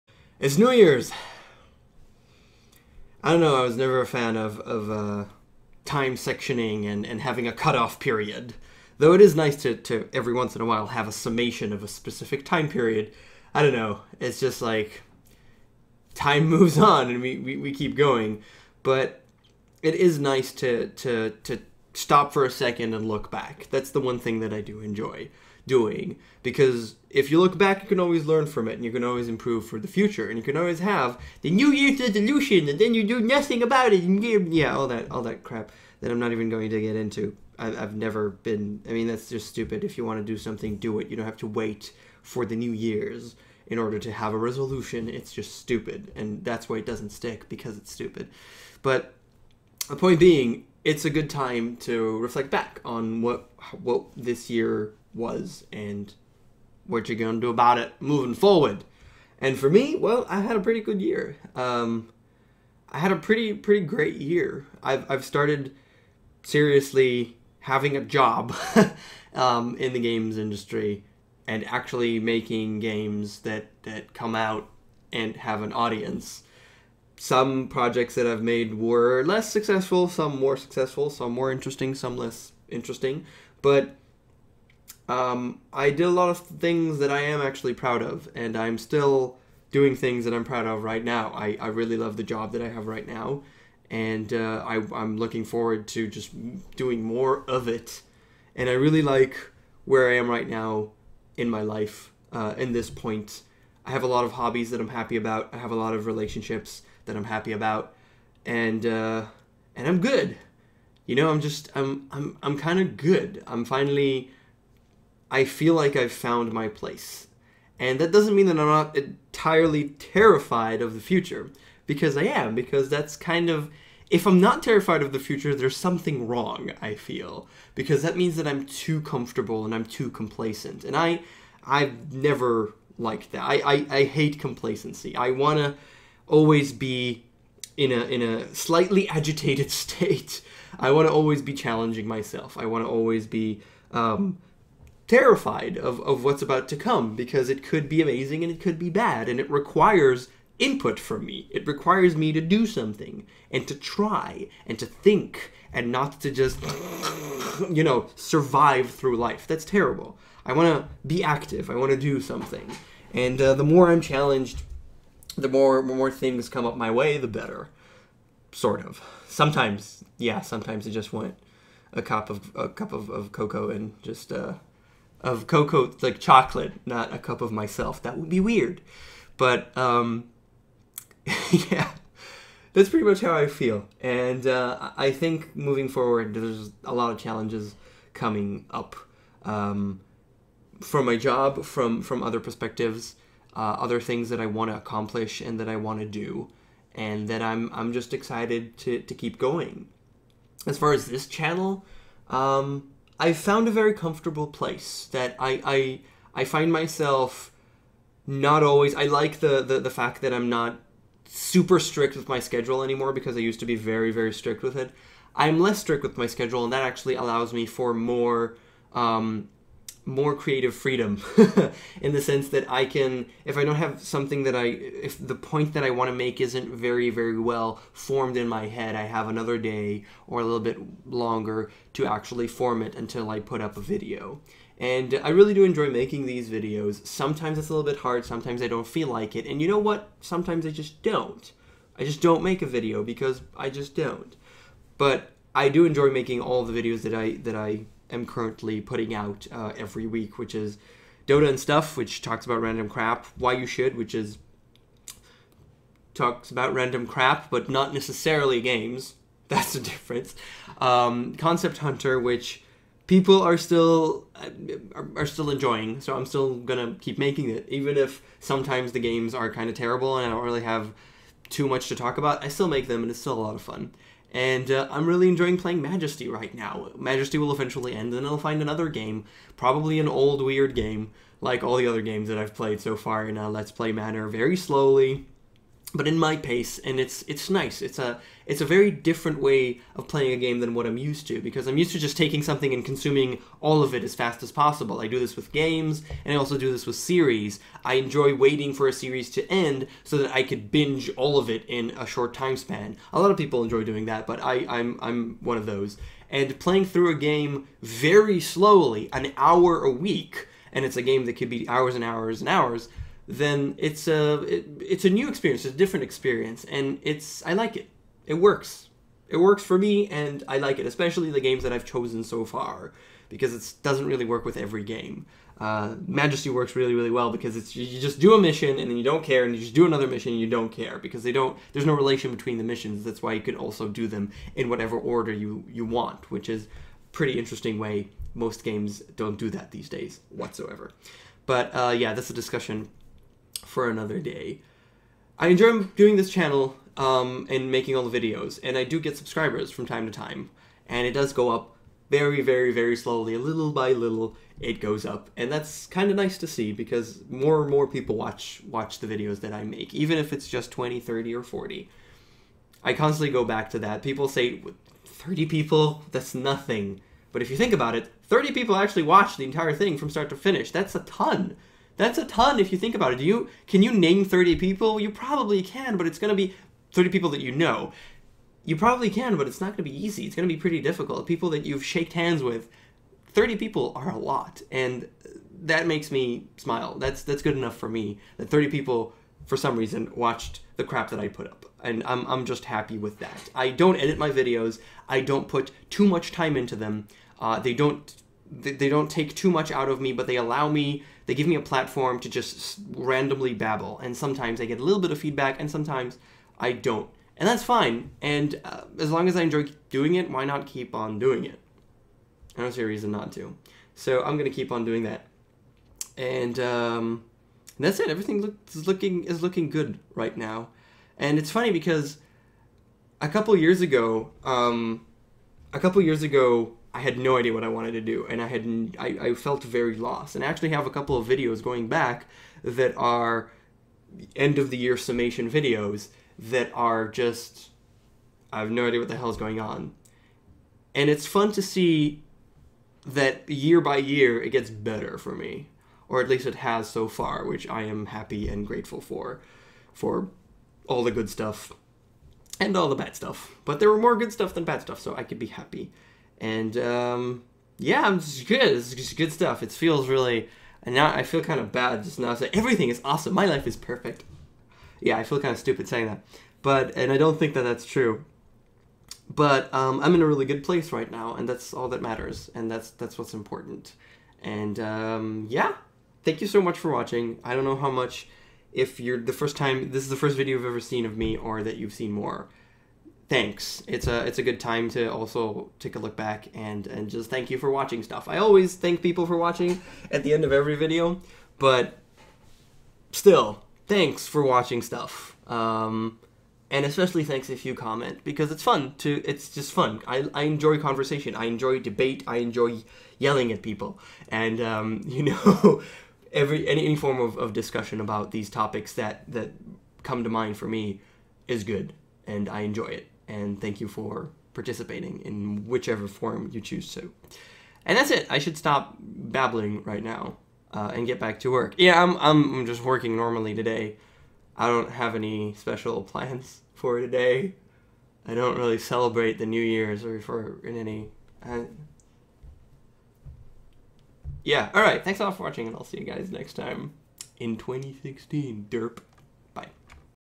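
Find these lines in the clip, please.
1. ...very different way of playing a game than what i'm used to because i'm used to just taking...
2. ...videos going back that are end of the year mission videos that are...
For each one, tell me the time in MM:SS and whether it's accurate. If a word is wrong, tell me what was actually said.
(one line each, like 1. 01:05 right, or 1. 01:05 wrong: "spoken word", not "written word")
1. 04:48 right
2. 07:11 wrong: "summation", not "mission".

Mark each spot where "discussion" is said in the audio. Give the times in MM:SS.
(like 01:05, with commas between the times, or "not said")
05:42, 08:27.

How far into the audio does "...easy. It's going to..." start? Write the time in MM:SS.
06:20.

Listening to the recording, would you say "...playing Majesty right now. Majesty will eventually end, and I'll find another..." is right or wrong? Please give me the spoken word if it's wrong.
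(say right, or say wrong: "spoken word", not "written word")
right.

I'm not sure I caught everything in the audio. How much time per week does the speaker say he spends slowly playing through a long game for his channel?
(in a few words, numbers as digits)
an hour a week.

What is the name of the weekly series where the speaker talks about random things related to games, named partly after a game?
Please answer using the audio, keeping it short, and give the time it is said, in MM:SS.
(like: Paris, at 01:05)
Dota and Stuff, at 04:11.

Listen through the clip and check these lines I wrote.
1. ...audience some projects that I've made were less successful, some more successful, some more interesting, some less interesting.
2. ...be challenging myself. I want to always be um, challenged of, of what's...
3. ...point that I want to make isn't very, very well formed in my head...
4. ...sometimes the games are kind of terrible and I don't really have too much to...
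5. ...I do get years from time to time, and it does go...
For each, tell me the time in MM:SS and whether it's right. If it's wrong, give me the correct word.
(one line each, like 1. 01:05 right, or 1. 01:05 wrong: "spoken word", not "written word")
1. 01:15 right
2. 02:21 wrong: "terrified", not "challenged"
3. 03:45 right
4. 04:28 right
5. 05:48 wrong: "subscribers", not "years".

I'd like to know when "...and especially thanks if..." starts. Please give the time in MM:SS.
08:16.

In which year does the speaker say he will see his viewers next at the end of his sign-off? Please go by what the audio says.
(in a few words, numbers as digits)
2016.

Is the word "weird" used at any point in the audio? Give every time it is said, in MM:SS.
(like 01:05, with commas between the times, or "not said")
02:58, 04:40.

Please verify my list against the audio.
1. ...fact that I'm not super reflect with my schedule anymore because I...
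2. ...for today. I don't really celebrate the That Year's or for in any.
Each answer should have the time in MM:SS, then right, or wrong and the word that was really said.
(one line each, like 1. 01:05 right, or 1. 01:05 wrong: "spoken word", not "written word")
1. 03:29 wrong: "strict", not "reflect"
2. 08:46 wrong: "New", not "That".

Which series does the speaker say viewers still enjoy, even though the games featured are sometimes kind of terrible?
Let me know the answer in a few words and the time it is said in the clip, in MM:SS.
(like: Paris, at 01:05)
Concept Hunter, at 04:21.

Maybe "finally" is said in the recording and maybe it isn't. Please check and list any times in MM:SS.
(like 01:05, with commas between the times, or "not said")
01:53.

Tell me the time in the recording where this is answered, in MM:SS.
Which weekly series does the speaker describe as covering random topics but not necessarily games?
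04:13.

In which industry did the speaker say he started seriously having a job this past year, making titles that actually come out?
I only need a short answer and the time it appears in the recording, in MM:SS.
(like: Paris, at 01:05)
games industry, at 01:09.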